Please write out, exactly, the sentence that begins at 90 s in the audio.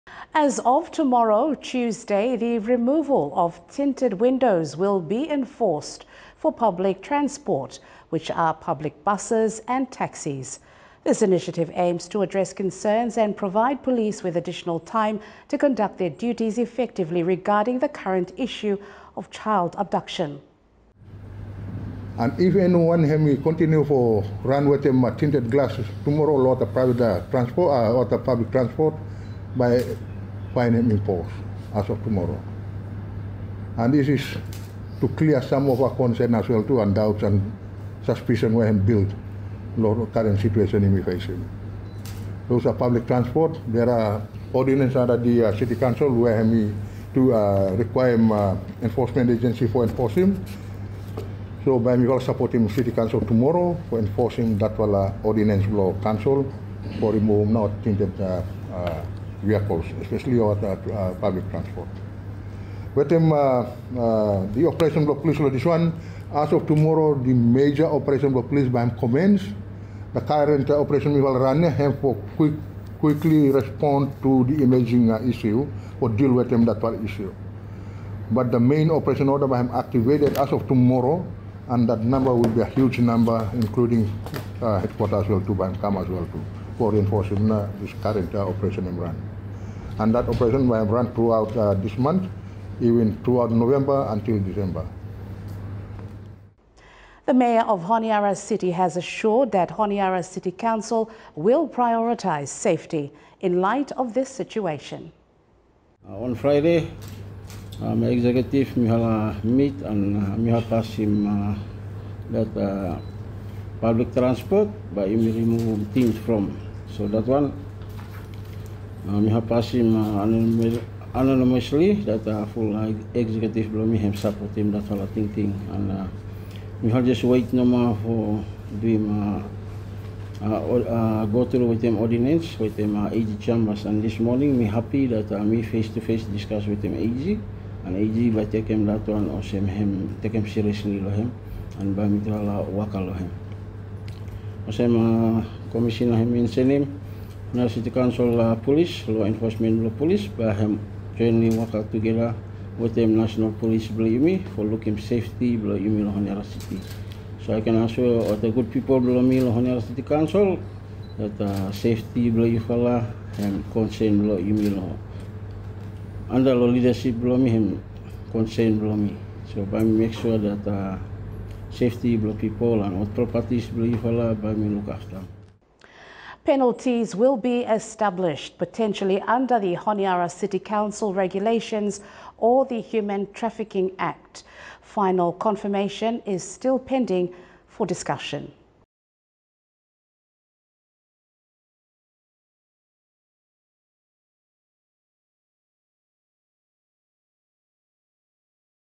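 And that operation will run throughout uh, this month, even throughout November until December.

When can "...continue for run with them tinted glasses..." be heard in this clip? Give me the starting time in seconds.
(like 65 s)
23 s.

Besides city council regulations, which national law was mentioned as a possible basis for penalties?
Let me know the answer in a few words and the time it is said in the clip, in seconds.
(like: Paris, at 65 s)
Human Trafficking Act, at 182 s.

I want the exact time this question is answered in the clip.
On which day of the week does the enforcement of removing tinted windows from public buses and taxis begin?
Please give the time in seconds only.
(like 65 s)
1 s.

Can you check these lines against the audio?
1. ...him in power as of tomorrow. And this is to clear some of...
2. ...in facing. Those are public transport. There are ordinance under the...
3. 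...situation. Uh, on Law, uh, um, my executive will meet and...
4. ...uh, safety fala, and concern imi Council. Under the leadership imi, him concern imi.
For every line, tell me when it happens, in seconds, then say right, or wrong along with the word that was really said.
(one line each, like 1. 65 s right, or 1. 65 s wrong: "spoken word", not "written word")
1. 30 s right
2. 40 s right
3. 104 s wrong: "Friday", not "Law"
4. 161 s wrong: "Loh", not "Council".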